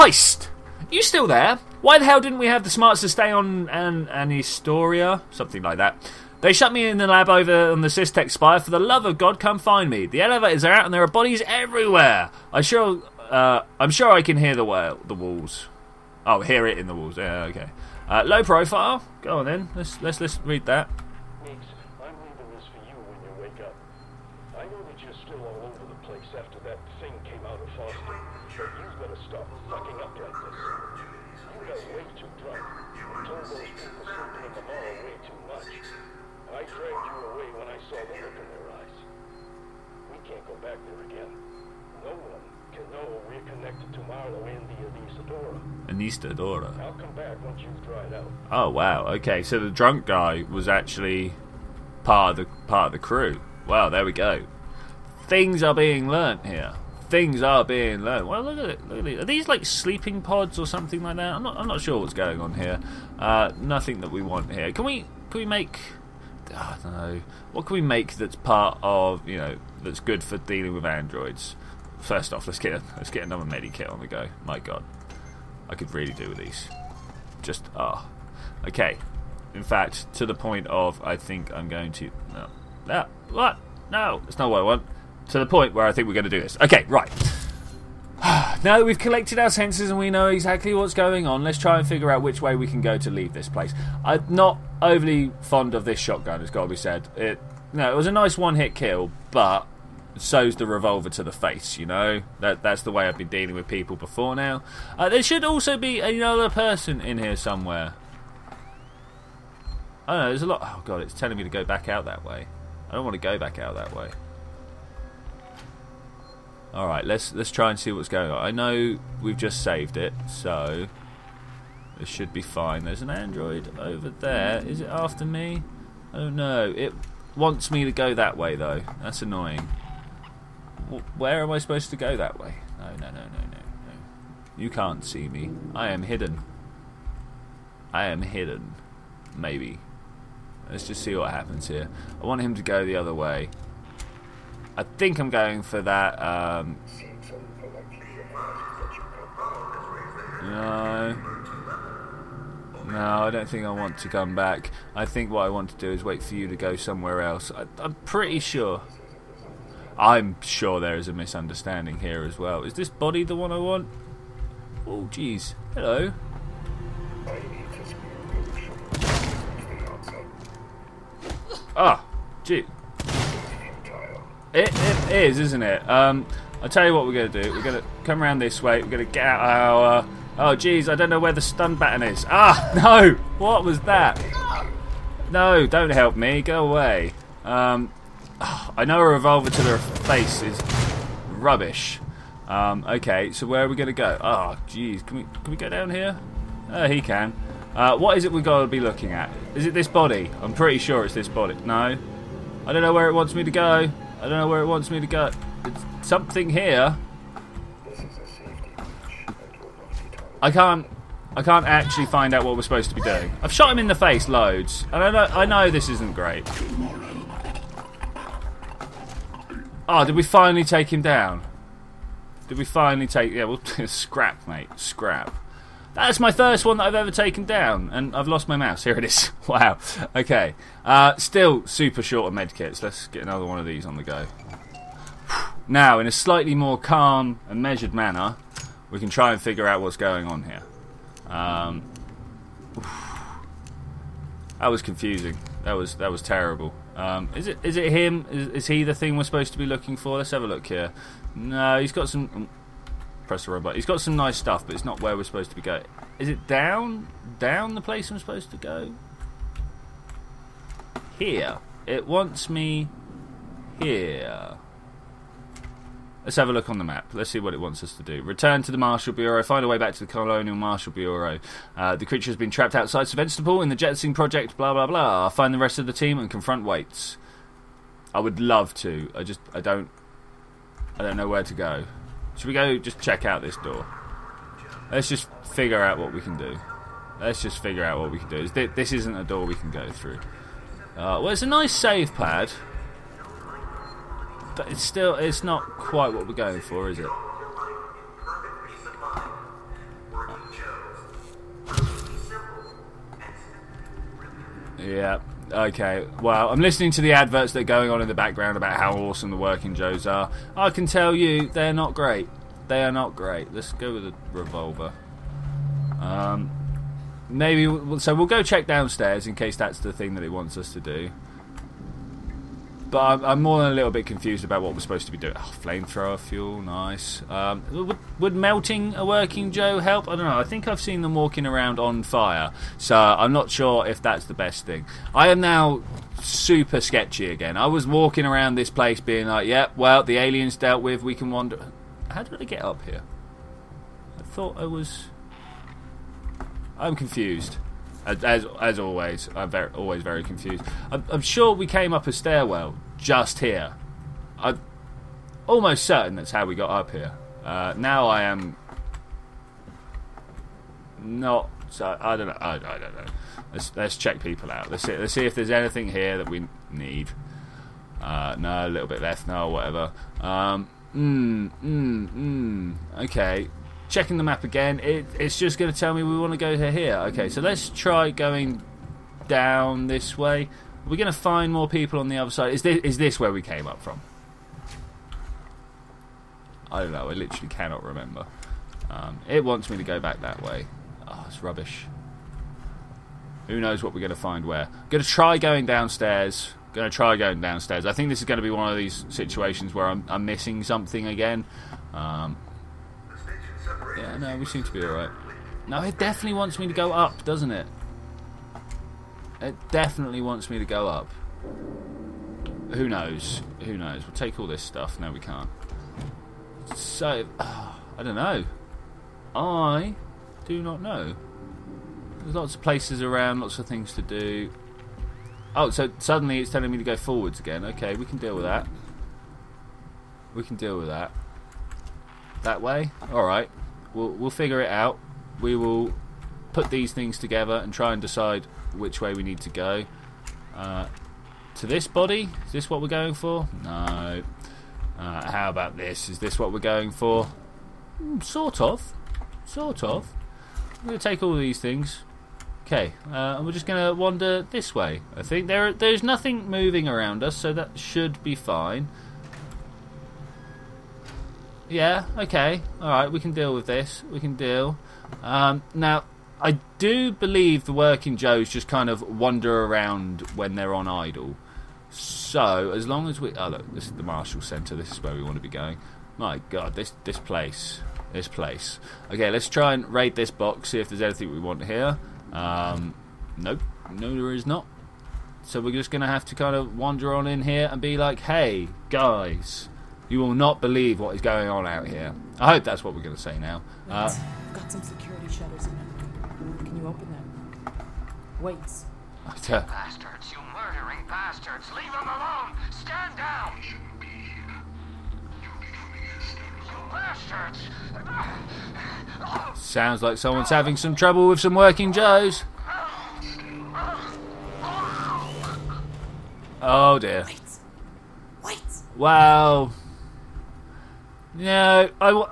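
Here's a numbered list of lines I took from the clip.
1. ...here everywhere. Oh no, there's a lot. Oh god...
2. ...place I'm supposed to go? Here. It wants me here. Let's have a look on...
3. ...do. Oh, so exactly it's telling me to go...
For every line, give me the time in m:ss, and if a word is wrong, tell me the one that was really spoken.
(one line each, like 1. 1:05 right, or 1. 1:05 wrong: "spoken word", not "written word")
1. 1:47 wrong: "somewhere", not "everywhere"
2. 4:17 right
3. 7:04 wrong: "suddenly", not "exactly".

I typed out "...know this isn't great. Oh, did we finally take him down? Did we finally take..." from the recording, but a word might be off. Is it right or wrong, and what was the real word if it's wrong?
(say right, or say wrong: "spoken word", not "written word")
right.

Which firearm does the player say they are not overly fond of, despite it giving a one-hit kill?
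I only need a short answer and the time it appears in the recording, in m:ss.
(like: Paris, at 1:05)
Shotgun, at 1:35.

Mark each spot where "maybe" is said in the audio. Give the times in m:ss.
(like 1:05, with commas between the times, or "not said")
2:19, 5:17.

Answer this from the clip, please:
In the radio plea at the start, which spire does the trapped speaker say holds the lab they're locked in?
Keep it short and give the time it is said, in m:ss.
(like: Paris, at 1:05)
Systech spire, at 0:07.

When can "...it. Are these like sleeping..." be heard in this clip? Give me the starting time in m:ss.
0:59.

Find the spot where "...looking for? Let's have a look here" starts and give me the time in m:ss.
4:09.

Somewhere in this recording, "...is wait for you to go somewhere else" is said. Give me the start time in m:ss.
2:35.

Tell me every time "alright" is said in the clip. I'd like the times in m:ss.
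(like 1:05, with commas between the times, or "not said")
6:44, 7:13, 7:42.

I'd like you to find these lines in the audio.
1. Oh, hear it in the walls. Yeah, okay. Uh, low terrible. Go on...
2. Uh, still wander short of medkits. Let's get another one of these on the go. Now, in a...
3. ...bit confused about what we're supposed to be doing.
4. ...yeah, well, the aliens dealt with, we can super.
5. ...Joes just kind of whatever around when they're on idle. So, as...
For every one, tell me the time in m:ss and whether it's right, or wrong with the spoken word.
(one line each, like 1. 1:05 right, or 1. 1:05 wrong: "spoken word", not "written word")
1. 0:16 wrong: "profile", not "terrible"
2. 3:50 wrong: "super", not "wander"
3. 5:23 right
4. 5:39 wrong: "wander", not "super"
5. 7:48 wrong: "wander", not "whatever".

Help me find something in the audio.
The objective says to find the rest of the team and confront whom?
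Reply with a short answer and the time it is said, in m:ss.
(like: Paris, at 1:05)
Waits, at 4:36.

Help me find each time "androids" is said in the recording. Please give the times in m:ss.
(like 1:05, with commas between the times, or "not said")
1:10, 2:03.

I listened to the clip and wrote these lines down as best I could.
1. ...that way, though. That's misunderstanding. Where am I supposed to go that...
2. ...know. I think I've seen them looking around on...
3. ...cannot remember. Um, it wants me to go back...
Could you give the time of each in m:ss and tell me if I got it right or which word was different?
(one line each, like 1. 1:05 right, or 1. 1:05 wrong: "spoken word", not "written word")
1. 2:08 wrong: "annoying", not "misunderstanding"
2. 5:30 wrong: "walking", not "looking"
3. 6:27 right.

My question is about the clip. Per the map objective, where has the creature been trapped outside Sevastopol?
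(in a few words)
Jetsing Project.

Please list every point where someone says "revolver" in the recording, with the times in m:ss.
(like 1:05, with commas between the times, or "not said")
1:40, 3:09, 5:14.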